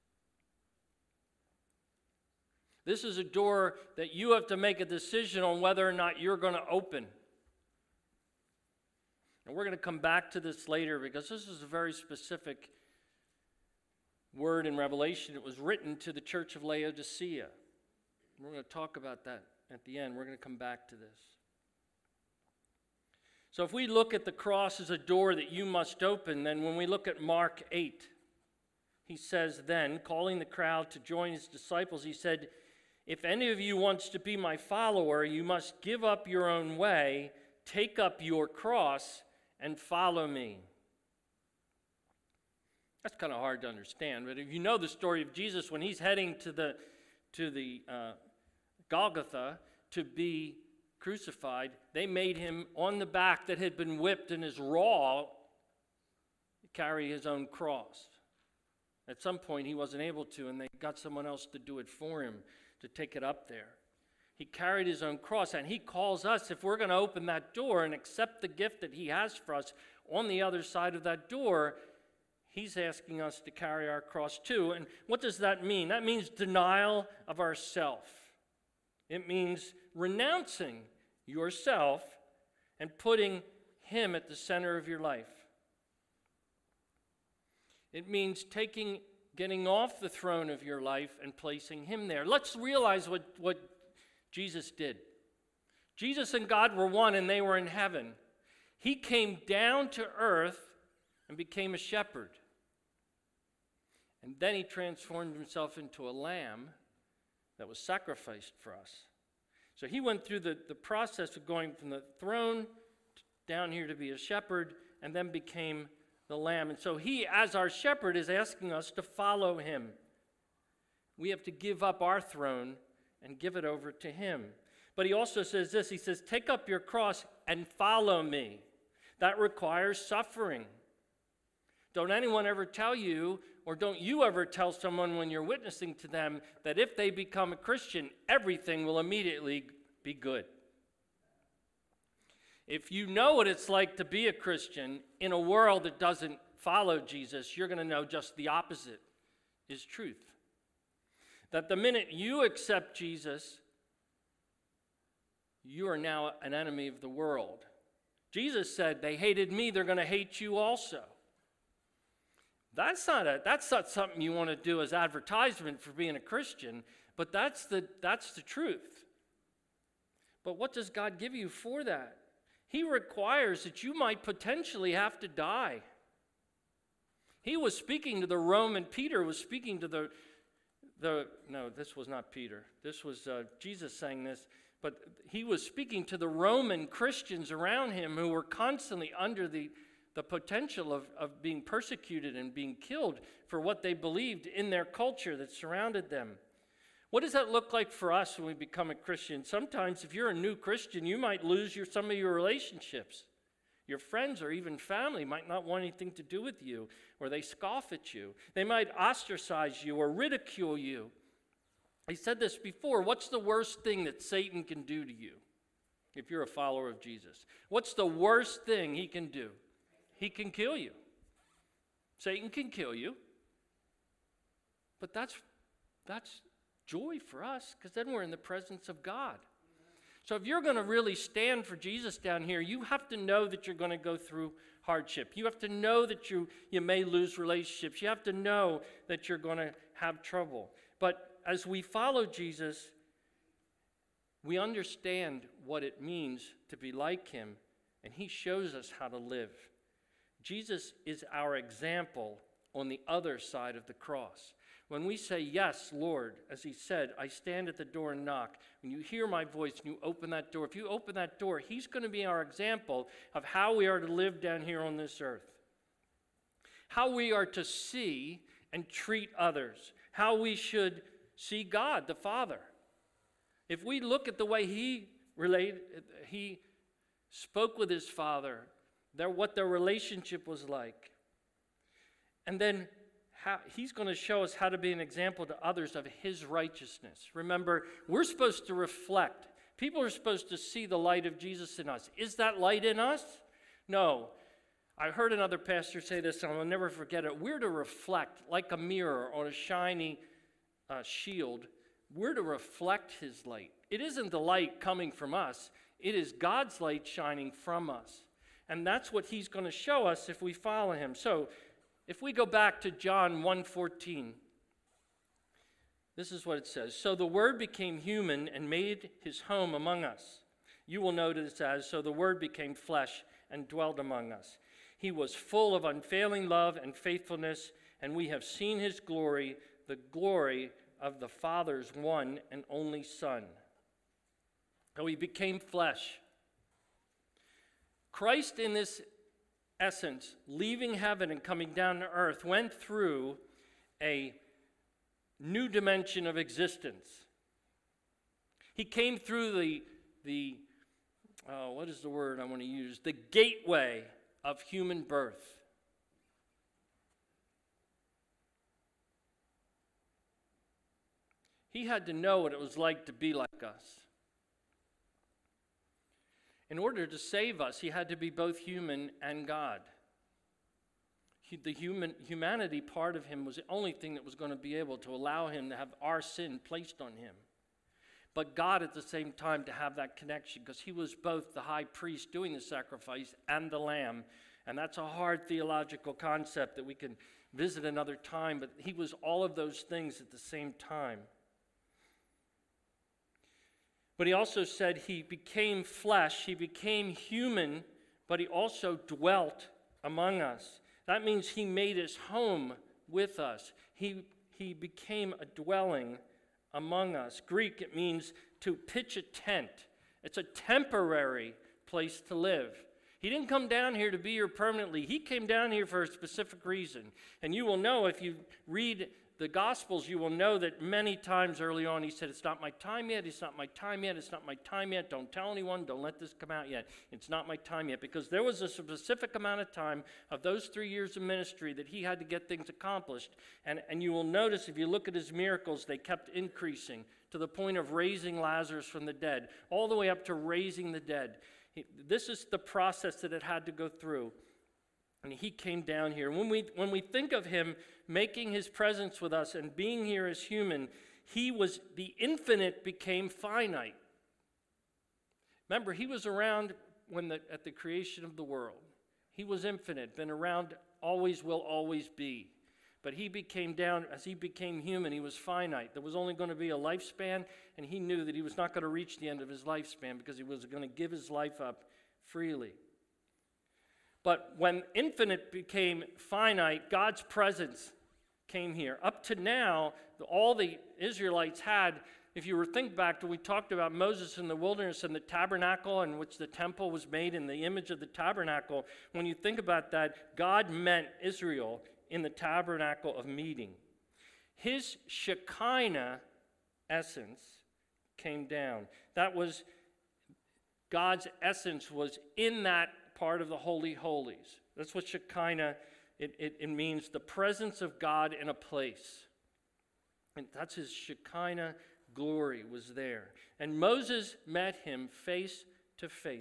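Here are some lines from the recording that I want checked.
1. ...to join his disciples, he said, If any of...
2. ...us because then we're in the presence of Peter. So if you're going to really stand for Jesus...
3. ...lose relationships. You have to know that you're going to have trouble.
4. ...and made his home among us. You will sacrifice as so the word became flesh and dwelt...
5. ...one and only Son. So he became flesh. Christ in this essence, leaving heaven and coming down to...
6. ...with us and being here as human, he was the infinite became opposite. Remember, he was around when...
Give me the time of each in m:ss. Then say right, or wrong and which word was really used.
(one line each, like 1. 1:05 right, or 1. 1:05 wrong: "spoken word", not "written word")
1. 0:30 right
2. 3:47 wrong: "God", not "Peter"
3. 3:57 right
4. 5:18 wrong: "notice", not "sacrifice"
5. 5:31 right
6. 7:29 wrong: "finite", not "opposite".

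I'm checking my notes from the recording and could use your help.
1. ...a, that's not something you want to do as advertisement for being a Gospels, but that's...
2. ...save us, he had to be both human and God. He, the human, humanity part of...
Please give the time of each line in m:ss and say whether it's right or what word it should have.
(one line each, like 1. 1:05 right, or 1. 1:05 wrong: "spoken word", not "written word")
1. 2:43 wrong: "Christian", not "Gospels"
2. 6:07 right.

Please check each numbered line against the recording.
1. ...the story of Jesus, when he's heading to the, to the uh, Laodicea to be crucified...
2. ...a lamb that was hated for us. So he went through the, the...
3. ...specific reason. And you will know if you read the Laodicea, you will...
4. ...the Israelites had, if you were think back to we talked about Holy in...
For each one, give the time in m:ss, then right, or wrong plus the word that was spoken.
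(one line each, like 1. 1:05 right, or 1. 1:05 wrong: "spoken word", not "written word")
1. 0:44 wrong: "Golgotha", not "Laodicea"
2. 1:46 wrong: "sacrificed", not "hated"
3. 6:56 wrong: "Gospels", not "Laodicea"
4. 8:00 wrong: "Moses", not "Holy".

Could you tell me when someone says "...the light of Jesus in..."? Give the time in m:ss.
4:50.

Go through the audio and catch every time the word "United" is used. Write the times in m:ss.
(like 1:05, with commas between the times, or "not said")
not said.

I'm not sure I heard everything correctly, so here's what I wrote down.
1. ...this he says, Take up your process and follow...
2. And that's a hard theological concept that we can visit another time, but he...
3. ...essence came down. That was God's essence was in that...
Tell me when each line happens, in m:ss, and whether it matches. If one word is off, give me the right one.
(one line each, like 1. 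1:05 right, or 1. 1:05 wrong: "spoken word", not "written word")
1. 2:05 wrong: "cross", not "process"
2. 6:24 right
3. 8:16 right.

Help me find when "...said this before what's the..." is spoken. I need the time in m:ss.
3:32.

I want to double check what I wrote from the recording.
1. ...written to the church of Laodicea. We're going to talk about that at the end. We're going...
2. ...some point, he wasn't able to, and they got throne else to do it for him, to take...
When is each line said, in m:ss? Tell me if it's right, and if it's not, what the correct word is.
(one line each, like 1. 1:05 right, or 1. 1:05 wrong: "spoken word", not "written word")
1. 0:15 right
2. 0:59 wrong: "someone", not "throne".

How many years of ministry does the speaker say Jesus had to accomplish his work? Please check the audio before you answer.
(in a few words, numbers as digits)
3.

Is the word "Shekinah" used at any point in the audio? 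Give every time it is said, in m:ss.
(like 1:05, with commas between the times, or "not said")
8:15, 8:25, 8:30.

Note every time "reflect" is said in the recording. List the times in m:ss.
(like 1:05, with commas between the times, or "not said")
4:48, 4:57, 5:02.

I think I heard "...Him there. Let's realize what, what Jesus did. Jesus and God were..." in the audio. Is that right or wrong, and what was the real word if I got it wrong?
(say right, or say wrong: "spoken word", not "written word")
right.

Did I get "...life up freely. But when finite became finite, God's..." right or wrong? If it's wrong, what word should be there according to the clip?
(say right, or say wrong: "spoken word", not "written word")
wrong: "infinite", not "finite".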